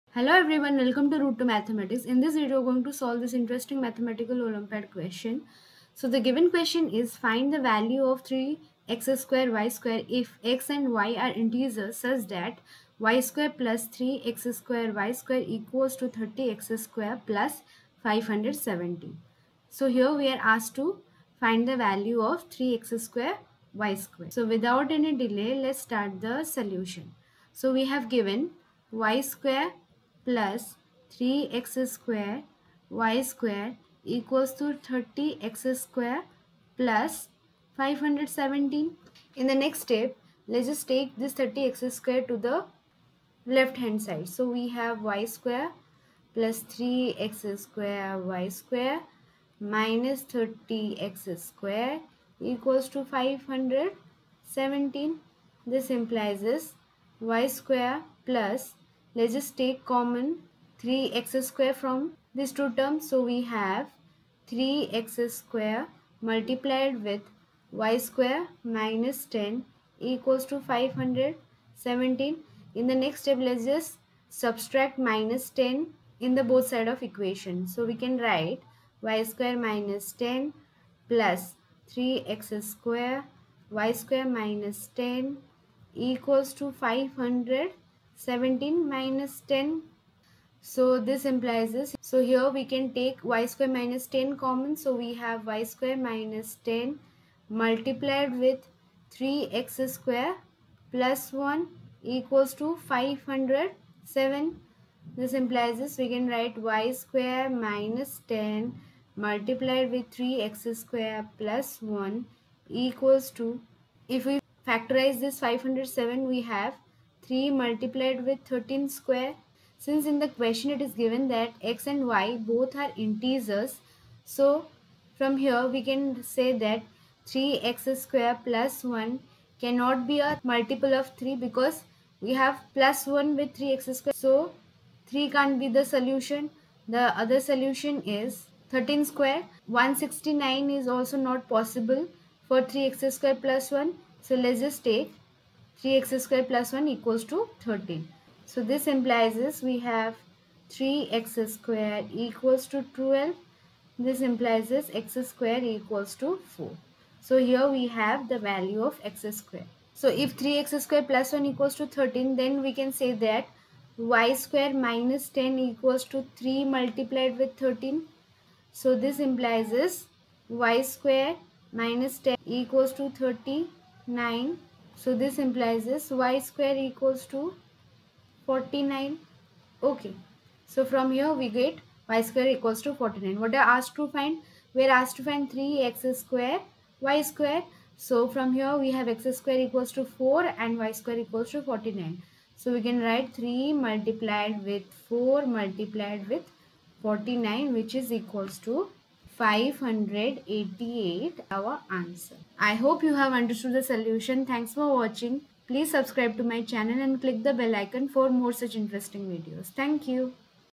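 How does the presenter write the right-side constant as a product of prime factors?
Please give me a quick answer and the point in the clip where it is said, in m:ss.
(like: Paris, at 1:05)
3 multiplied with 13 square, at 1:57.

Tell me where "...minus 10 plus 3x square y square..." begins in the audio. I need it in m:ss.
1:19.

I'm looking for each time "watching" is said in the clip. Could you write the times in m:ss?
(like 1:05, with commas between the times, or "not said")
3:24.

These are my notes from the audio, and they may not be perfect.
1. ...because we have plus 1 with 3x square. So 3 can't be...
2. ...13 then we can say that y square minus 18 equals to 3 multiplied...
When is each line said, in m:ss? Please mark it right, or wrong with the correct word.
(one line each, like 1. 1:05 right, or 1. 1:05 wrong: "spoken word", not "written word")
1. 2:11 right
2. 2:41 wrong: "10", not "18".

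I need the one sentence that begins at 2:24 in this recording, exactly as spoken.
So let's just take 3x square plus 1 equals to 13.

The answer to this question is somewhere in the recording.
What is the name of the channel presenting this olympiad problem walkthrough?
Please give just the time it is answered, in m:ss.
0:01.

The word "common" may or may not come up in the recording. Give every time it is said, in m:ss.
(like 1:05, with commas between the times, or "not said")
0:59, 1:34.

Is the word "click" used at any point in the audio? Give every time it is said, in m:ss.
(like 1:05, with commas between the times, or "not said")
3:27.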